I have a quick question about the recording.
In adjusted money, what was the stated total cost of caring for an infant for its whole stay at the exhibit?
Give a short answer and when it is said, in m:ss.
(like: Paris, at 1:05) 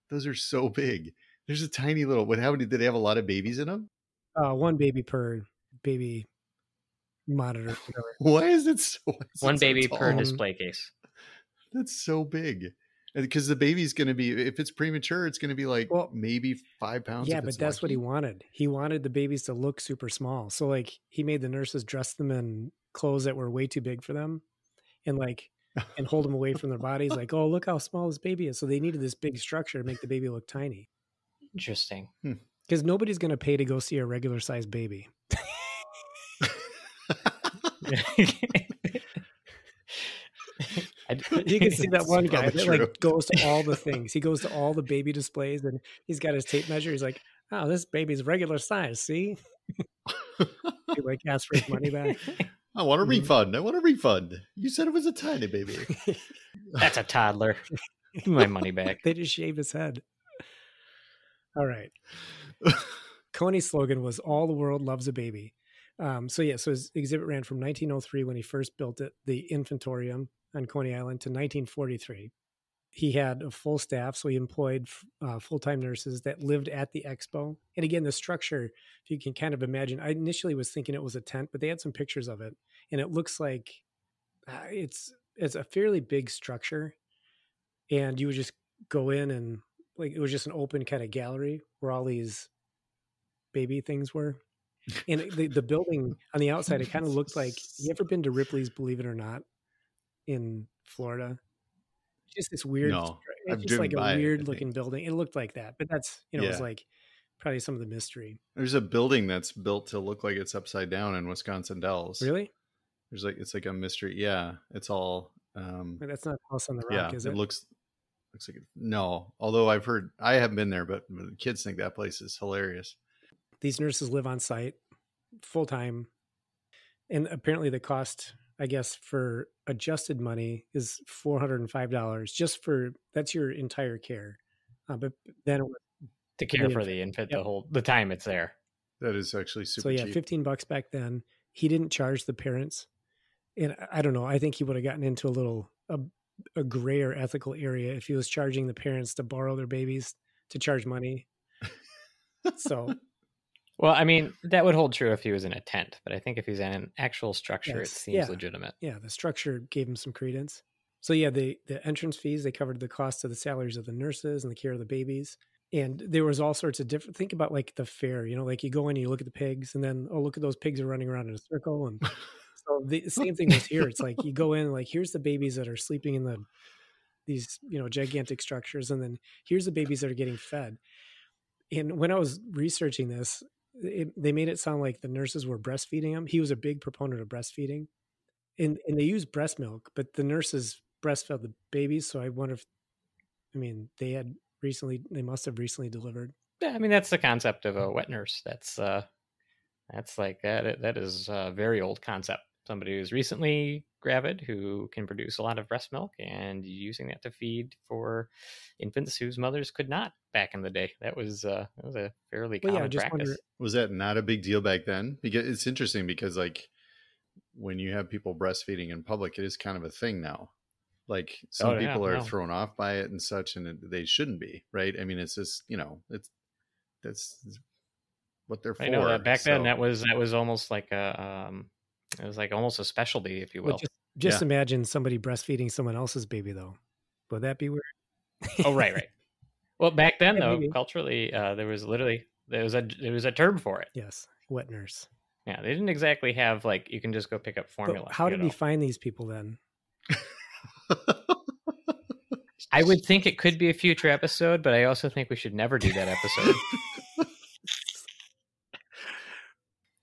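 $405, at 2:11.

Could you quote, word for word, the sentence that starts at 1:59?
Although I've heard I haven't been there, but, but the kids think that place is hilarious.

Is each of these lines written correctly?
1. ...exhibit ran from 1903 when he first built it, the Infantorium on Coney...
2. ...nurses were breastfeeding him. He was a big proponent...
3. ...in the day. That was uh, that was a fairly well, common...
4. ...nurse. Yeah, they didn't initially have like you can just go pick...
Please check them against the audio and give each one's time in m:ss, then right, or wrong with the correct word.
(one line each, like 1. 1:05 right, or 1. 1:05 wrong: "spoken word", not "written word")
1. 1:06 right
2. 3:05 right
3. 3:30 right
4. 4:04 wrong: "exactly", not "initially".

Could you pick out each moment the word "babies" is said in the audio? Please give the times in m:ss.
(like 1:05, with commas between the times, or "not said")
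0:03, 0:19, 2:29, 2:44, 2:55, 2:59, 3:11.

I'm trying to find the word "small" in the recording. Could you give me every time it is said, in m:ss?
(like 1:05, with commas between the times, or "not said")
0:20, 0:27.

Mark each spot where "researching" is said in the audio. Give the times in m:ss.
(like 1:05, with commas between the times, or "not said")
3:02.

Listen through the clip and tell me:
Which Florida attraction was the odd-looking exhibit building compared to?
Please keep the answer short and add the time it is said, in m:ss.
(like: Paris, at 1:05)
Ripley's Believe It or Not, at 1:38.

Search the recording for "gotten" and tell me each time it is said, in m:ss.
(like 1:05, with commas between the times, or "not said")
2:24.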